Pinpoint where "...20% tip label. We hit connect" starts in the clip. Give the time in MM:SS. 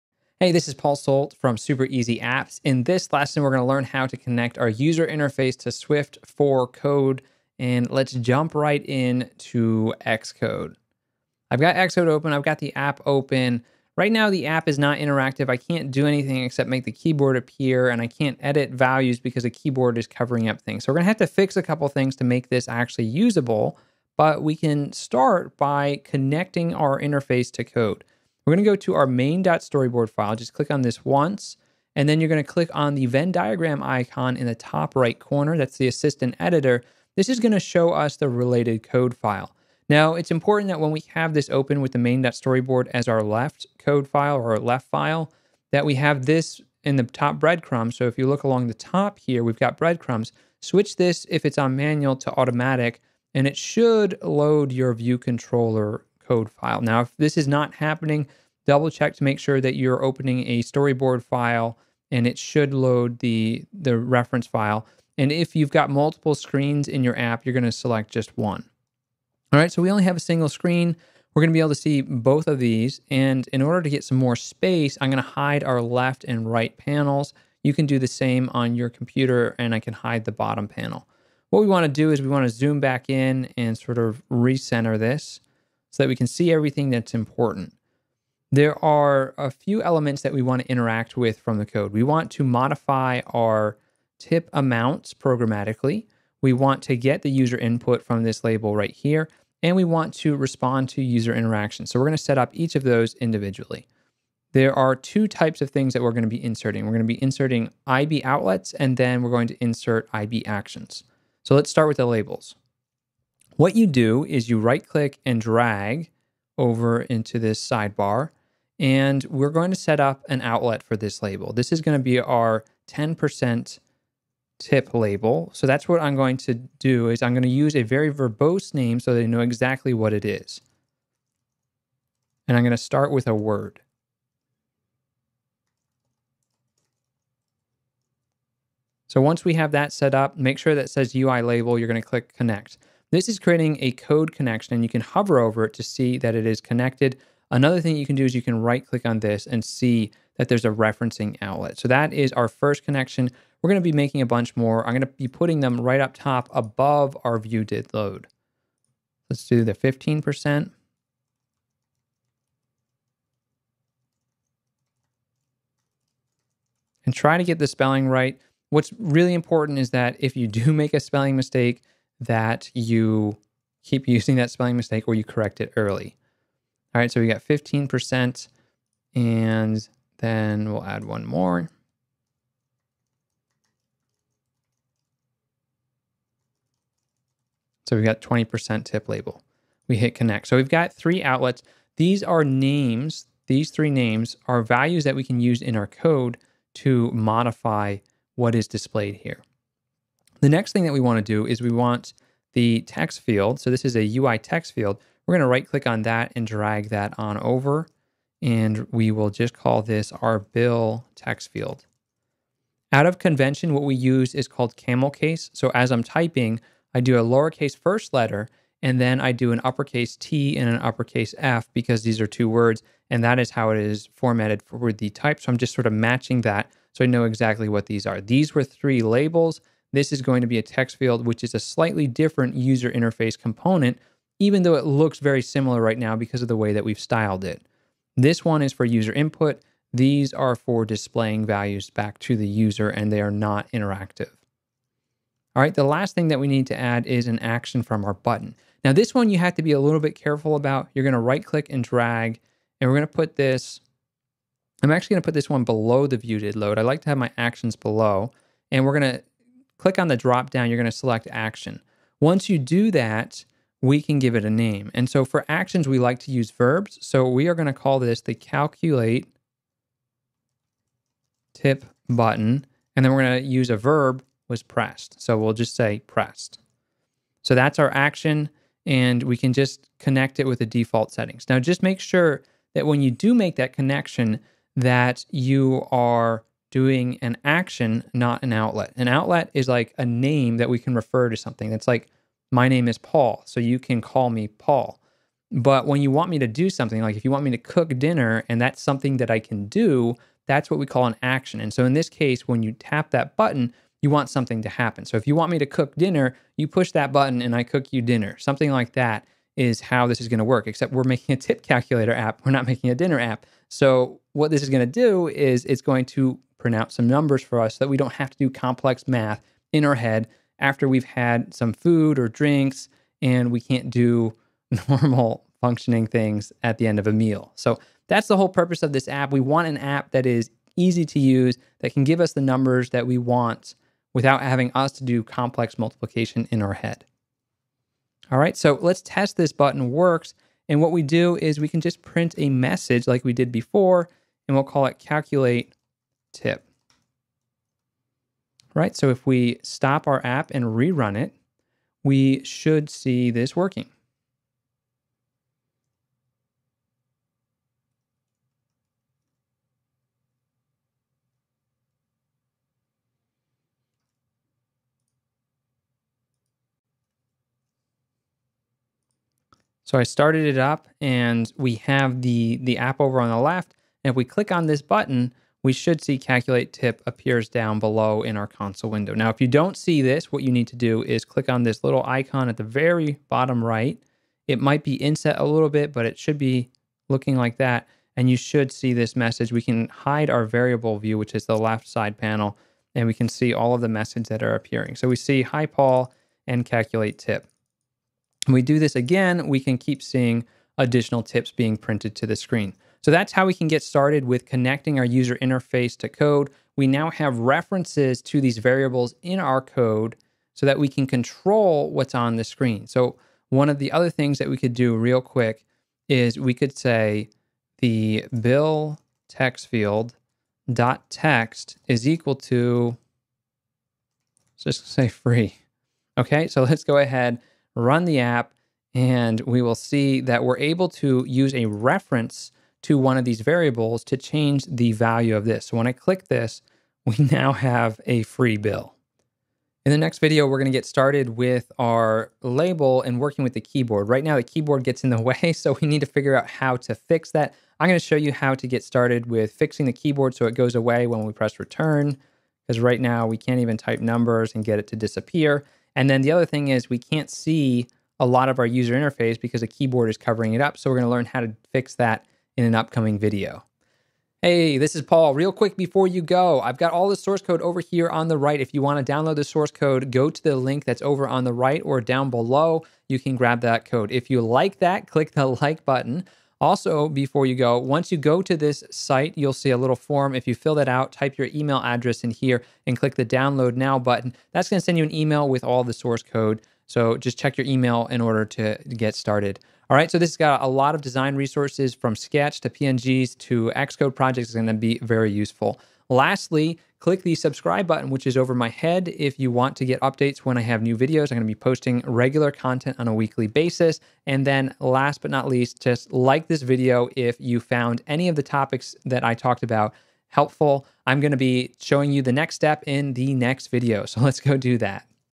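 03:08.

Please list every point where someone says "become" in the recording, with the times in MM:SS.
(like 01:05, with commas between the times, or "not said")
not said.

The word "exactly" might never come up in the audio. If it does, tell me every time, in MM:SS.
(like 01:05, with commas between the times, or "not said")
02:09, 03:47.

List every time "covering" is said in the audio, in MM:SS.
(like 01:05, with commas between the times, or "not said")
00:20, 07:40.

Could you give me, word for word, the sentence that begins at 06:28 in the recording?
And you should see this message.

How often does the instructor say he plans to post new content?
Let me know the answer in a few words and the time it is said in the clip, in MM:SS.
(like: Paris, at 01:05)
weekly, at 08:23.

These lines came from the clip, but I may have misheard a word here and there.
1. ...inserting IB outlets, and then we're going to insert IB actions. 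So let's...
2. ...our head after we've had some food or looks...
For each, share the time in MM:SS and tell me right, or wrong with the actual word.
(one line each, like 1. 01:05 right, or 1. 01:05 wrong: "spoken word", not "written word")
1. 01:47 right
2. 05:19 wrong: "drinks", not "looks".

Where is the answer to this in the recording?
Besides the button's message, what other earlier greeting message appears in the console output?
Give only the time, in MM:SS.
06:35.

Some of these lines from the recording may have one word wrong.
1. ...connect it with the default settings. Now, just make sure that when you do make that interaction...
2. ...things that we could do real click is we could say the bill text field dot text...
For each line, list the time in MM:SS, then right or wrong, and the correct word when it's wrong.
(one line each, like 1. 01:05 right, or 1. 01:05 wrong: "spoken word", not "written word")
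1. 04:39 wrong: "connection", not "interaction"
2. 06:54 wrong: "quick", not "click".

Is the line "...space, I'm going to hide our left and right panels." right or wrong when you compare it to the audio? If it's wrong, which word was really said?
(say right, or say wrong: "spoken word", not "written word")
right.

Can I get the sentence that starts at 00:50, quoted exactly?
Switch this, if it's on manual, to automatic, and it should load your view controller code file.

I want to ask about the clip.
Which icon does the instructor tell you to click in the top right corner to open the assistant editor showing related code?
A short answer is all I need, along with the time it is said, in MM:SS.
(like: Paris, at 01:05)
Venn diagram icon, at 00:33.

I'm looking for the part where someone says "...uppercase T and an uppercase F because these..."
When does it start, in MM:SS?
03:39.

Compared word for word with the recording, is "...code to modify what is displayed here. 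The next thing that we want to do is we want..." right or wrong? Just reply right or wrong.
right.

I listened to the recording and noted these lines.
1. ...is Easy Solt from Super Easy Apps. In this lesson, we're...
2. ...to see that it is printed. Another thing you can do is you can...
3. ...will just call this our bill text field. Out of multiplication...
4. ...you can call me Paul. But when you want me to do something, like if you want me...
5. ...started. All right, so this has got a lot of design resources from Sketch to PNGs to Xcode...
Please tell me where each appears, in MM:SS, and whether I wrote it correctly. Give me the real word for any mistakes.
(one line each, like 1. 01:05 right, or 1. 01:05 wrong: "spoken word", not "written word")
1. 00:00 wrong: "Paul", not "Easy"
2. 02:25 wrong: "connected", not "printed"
3. 03:29 wrong: "convention", not "multiplication"
4. 04:53 right
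5. 08:09 right.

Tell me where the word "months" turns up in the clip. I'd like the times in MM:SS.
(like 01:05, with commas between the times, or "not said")
not said.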